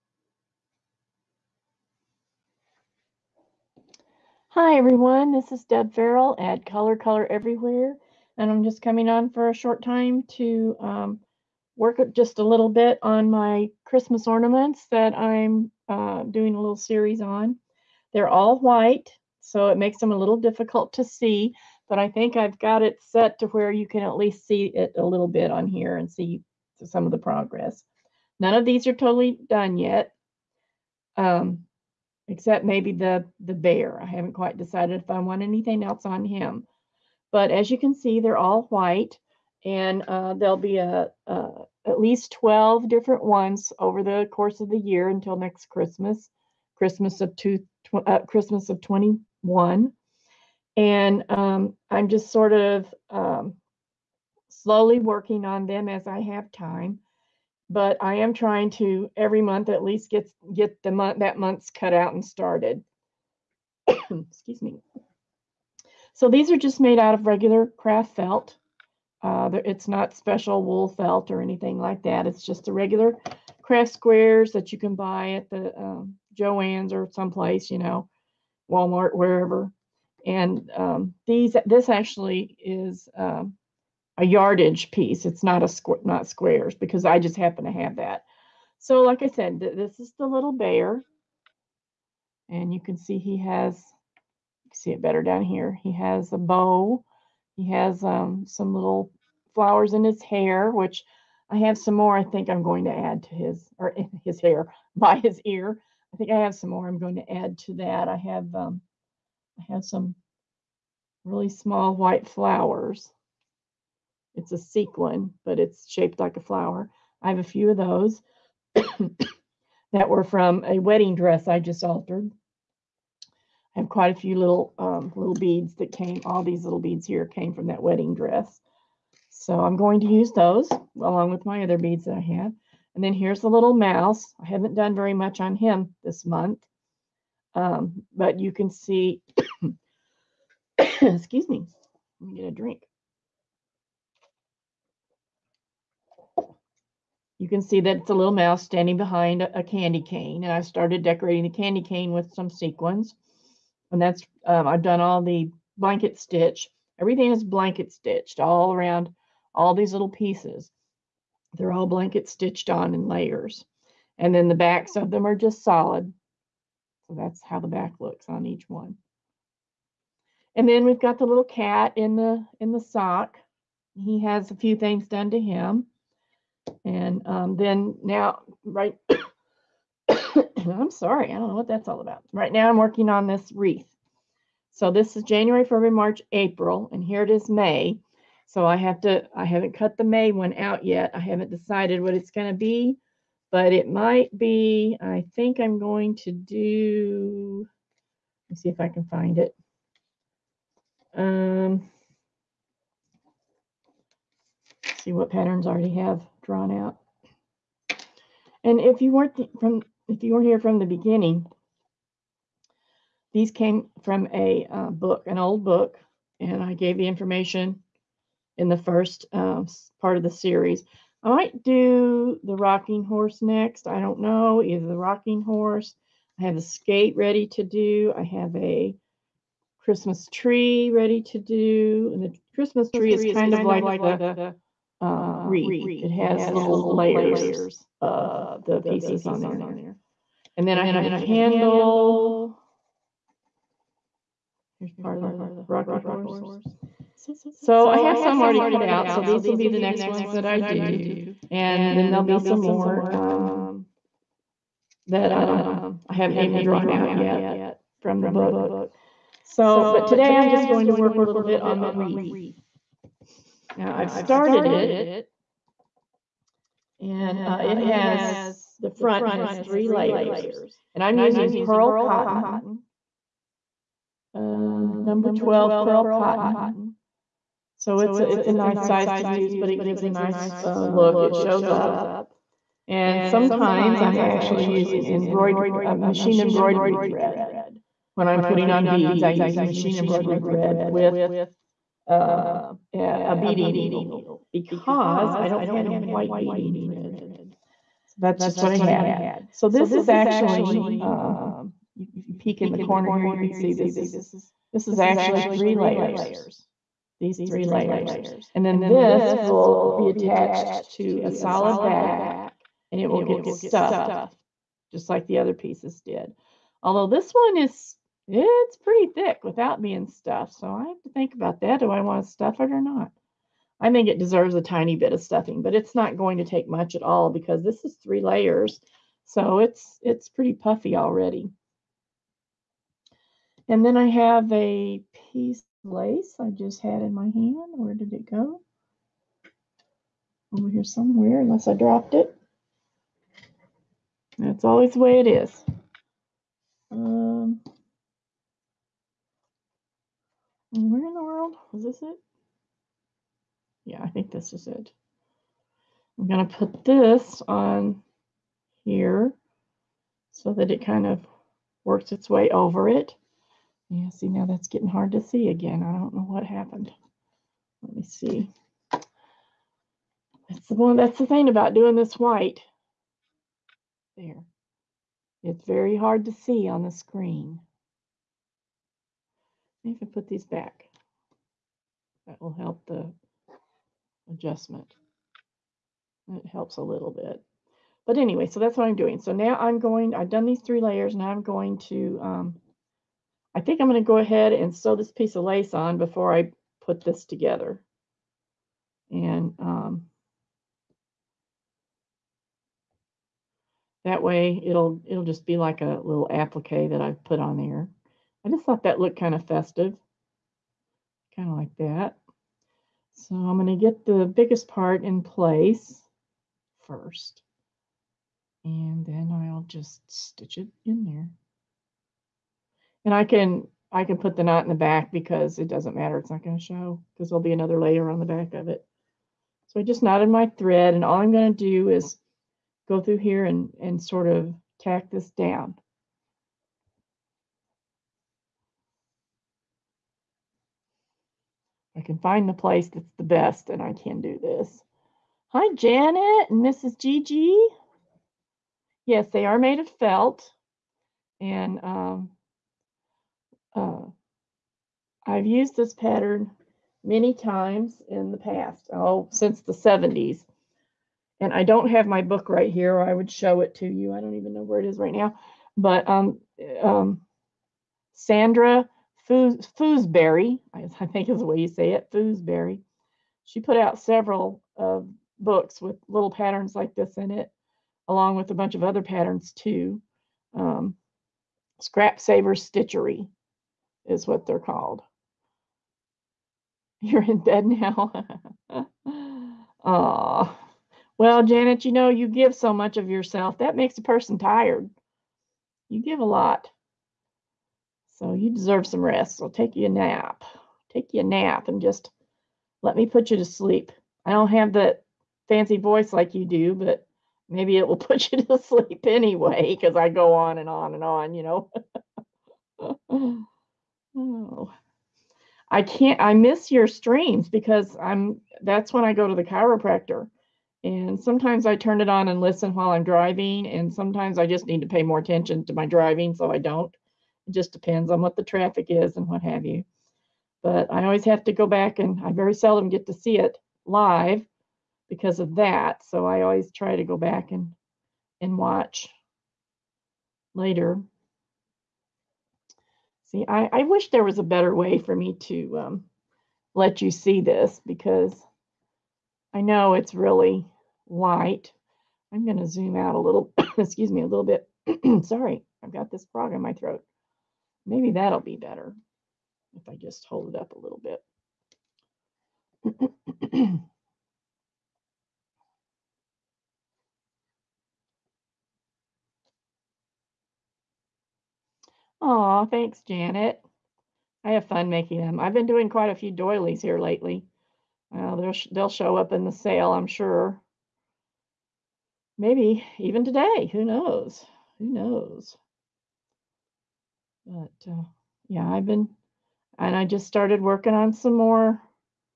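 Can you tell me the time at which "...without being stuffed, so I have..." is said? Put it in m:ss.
5:19.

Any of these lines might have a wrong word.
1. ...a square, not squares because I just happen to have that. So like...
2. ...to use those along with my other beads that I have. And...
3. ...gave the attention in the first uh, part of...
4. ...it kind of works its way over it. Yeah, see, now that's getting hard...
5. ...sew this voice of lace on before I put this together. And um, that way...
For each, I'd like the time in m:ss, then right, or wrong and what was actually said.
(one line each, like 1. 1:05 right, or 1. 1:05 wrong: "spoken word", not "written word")
1. 1:25 right
2. 2:10 right
3. 3:36 wrong: "information", not "attention"
4. 6:00 right
5. 6:34 wrong: "piece", not "voice".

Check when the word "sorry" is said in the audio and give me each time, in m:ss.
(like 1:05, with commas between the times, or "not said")
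3:00, 9:15.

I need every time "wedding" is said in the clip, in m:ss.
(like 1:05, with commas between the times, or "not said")
2:00, 2:07.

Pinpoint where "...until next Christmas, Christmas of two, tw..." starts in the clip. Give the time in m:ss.
0:45.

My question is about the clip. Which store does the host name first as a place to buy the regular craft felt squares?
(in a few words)
Joann's.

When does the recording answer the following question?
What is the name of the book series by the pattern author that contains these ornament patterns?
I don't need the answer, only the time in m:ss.
8:01.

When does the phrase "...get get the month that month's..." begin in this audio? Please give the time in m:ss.
1:00.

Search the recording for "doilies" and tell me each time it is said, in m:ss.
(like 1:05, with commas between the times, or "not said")
9:36.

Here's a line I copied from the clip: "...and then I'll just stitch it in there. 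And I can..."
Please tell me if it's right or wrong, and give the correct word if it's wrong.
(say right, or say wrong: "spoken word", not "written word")
right.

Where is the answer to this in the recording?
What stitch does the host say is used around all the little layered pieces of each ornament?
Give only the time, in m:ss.
2:35.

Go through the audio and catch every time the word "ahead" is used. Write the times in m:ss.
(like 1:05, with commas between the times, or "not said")
6:34.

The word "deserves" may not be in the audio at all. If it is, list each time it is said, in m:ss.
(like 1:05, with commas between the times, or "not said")
5:24, 8:18.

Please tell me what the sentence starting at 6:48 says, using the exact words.
I just thought that looked kind of festive, kind of like that.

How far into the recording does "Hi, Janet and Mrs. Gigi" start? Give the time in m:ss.
7:25.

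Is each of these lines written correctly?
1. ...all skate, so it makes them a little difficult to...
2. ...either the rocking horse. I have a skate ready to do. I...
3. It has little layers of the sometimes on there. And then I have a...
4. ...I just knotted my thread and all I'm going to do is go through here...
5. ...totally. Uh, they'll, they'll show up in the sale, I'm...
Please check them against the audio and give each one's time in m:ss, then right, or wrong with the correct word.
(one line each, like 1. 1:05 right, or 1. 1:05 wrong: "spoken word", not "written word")
1. 0:18 wrong: "white", not "skate"
2. 3:44 right
3. 3:56 wrong: "pieces", not "sometimes"
4. 7:09 right
5. 9:36 wrong: "lately", not "totally".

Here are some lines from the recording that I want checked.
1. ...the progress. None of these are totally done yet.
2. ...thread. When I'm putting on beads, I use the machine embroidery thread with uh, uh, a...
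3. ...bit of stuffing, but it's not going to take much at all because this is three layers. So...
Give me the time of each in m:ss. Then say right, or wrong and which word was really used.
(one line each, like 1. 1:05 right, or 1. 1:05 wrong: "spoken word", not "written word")
1. 0:27 right
2. 4:46 right
3. 5:24 right.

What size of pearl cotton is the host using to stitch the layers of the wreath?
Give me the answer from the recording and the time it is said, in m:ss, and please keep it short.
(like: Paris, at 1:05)
12, at 4:35.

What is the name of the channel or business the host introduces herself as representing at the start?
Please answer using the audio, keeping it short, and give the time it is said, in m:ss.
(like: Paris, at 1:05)
Color Color Everywhere, at 0:06.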